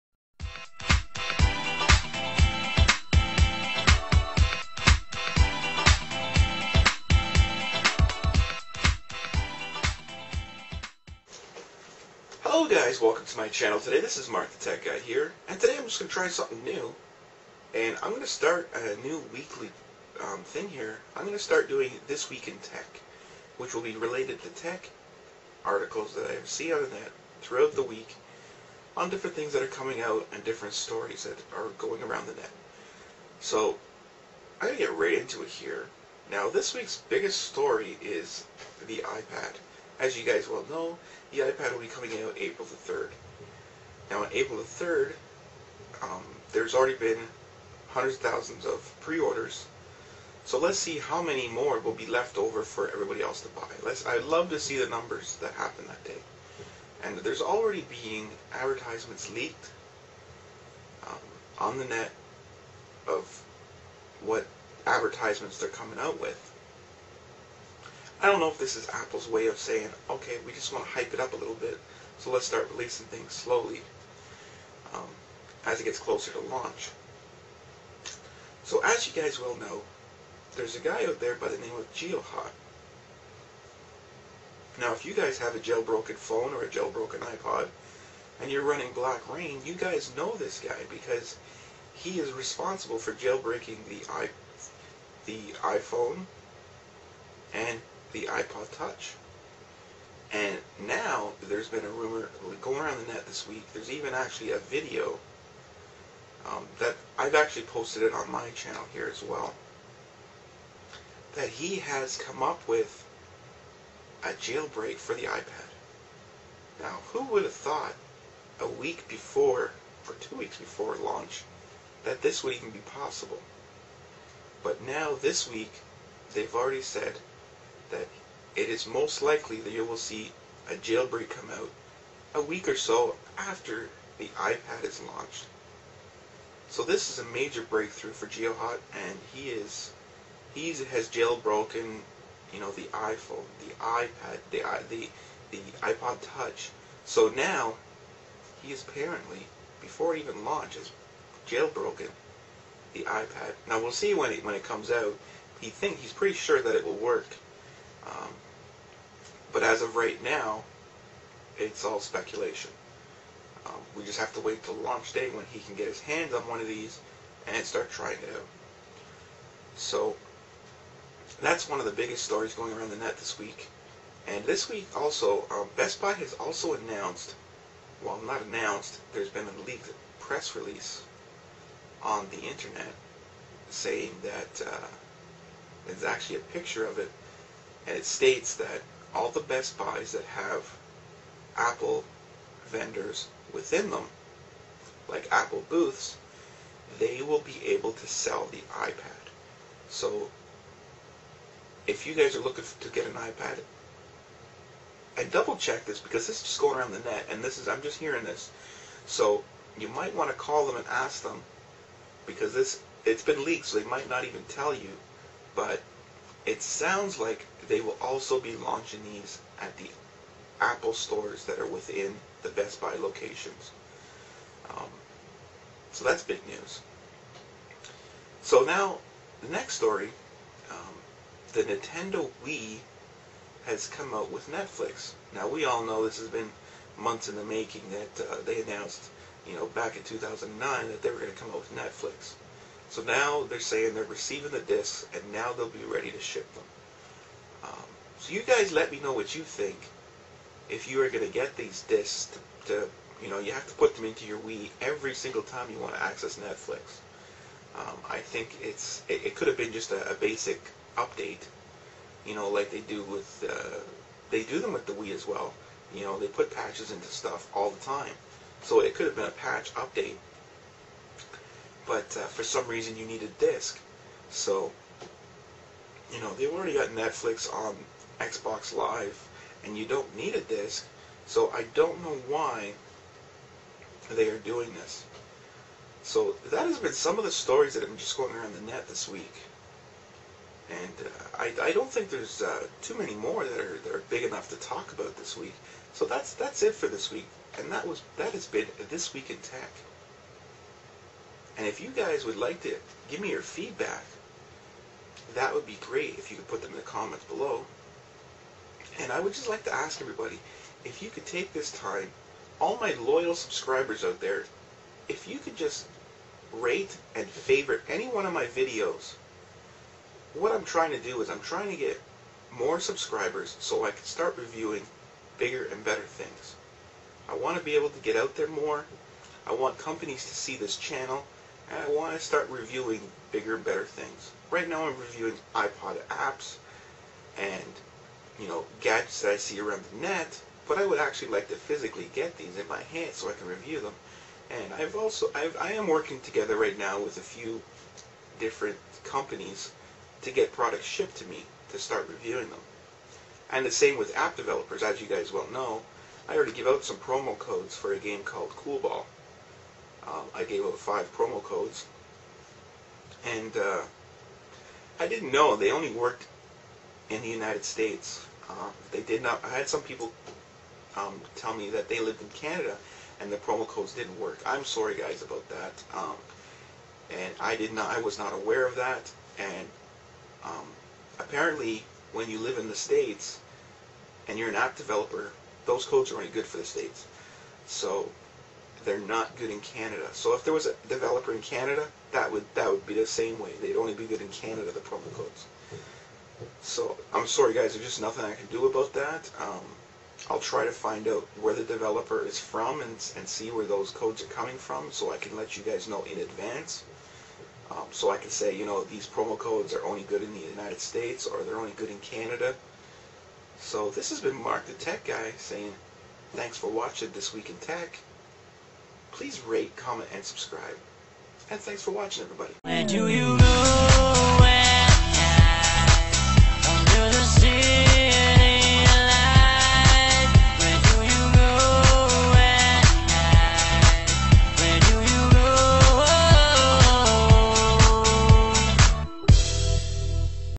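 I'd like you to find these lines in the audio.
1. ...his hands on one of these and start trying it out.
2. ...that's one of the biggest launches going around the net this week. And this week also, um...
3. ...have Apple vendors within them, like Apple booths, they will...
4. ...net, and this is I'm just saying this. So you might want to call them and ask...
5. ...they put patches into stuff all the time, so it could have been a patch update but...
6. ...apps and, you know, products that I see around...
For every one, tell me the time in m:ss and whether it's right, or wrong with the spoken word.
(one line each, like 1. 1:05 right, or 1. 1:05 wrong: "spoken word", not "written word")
1. 2:45 right
2. 2:51 wrong: "stories", not "launches"
3. 3:10 right
4. 3:27 wrong: "hearing", not "saying"
5. 4:26 right
6. 5:36 wrong: "gadgets", not "products".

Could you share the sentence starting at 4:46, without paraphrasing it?
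So that has been some of the stories that have been just going around the net this week.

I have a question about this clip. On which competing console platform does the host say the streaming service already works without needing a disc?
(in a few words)
Xbox Live.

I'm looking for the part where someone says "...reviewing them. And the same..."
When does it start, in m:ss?
5:52.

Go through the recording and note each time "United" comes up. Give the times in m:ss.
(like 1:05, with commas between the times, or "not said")
6:07, 6:50.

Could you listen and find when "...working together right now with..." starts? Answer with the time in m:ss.
5:45.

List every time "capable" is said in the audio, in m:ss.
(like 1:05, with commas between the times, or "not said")
not said.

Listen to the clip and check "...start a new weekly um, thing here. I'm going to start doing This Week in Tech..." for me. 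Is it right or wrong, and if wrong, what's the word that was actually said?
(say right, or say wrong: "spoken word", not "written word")
right.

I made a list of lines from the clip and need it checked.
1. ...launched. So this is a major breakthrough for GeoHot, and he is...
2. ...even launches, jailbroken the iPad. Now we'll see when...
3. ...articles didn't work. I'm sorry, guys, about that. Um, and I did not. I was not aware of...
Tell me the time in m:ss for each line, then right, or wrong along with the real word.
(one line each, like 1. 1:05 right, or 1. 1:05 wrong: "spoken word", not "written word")
1. 2:15 right
2. 2:30 right
3. 6:13 wrong: "codes", not "articles".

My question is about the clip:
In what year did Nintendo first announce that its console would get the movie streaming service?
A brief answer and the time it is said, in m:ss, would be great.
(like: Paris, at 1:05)
2009, at 4:00.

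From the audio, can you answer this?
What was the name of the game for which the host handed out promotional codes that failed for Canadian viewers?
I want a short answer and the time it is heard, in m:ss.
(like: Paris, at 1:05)
Coolball, at 5:58.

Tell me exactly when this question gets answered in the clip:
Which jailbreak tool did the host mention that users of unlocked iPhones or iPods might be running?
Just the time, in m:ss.
1:28.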